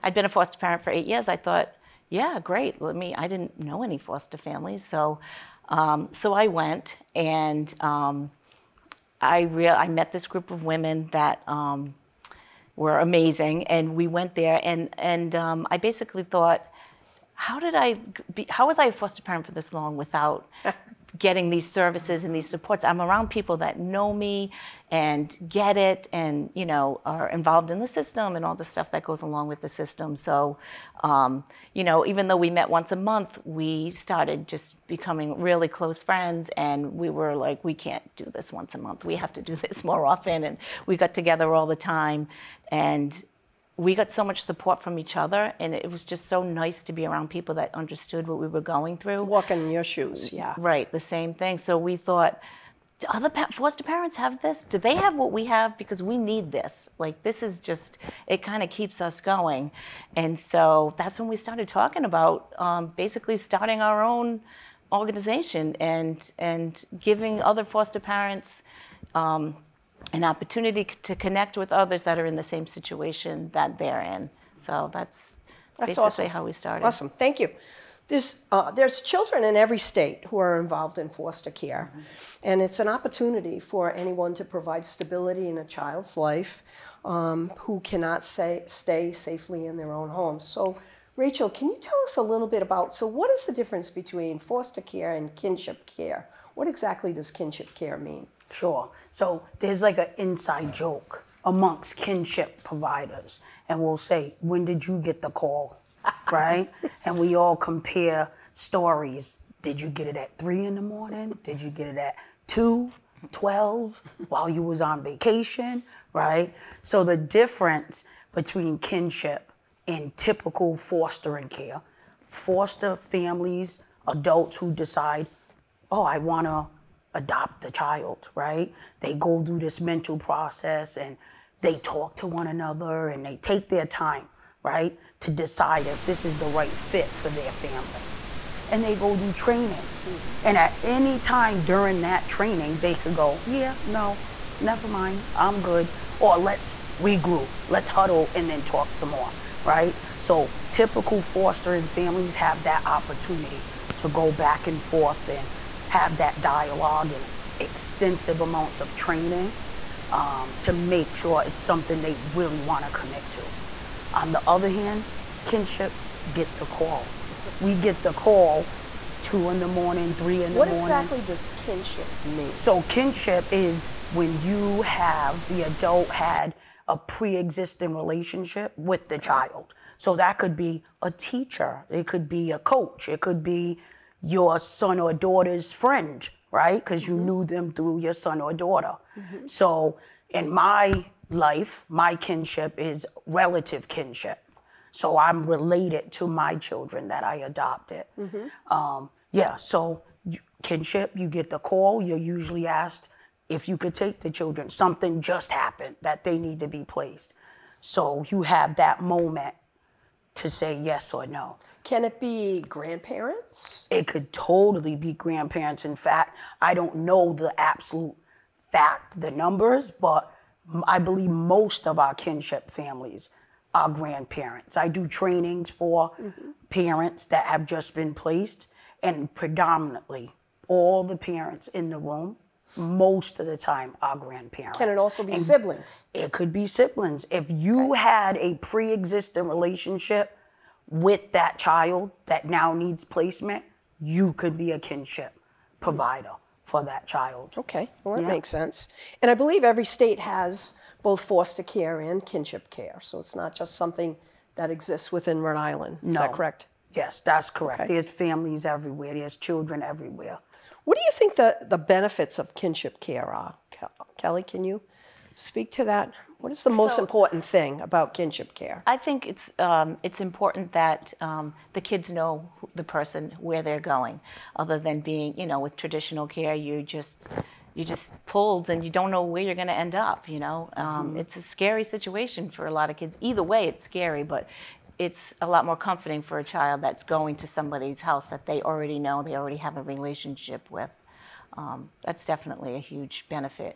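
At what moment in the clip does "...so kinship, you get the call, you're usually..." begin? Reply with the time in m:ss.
3:19.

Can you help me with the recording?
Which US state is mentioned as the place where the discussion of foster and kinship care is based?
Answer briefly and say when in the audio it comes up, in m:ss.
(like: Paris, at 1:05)
Rhode Island, at 4:15.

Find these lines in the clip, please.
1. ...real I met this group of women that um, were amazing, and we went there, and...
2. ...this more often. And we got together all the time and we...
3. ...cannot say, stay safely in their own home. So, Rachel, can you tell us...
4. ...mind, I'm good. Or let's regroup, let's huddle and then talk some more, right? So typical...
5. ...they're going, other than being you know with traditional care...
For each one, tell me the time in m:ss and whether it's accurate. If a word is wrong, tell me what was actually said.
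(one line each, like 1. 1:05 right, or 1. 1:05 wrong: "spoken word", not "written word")
1. 0:09 right
2. 0:39 right
3. 1:27 right
4. 2:24 right
5. 4:33 right.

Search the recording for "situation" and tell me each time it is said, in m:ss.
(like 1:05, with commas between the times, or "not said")
1:12, 4:41.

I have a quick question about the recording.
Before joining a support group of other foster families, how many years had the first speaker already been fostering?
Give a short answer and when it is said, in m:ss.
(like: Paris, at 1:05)
8, at 0:00.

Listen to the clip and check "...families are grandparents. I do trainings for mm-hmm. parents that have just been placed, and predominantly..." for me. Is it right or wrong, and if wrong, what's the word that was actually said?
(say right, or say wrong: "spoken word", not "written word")
right.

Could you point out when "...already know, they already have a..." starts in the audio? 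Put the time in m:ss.
4:48.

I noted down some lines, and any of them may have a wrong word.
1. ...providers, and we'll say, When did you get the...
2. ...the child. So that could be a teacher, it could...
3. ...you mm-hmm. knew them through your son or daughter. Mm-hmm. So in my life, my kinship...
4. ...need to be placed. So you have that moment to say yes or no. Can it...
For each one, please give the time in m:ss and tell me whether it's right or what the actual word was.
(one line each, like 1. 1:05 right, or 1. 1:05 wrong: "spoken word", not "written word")
1. 1:42 right
2. 2:59 right
3. 3:07 right
4. 3:26 right.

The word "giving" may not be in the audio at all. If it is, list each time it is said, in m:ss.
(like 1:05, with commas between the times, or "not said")
1:06.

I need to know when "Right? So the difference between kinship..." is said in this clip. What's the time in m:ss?
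1:56.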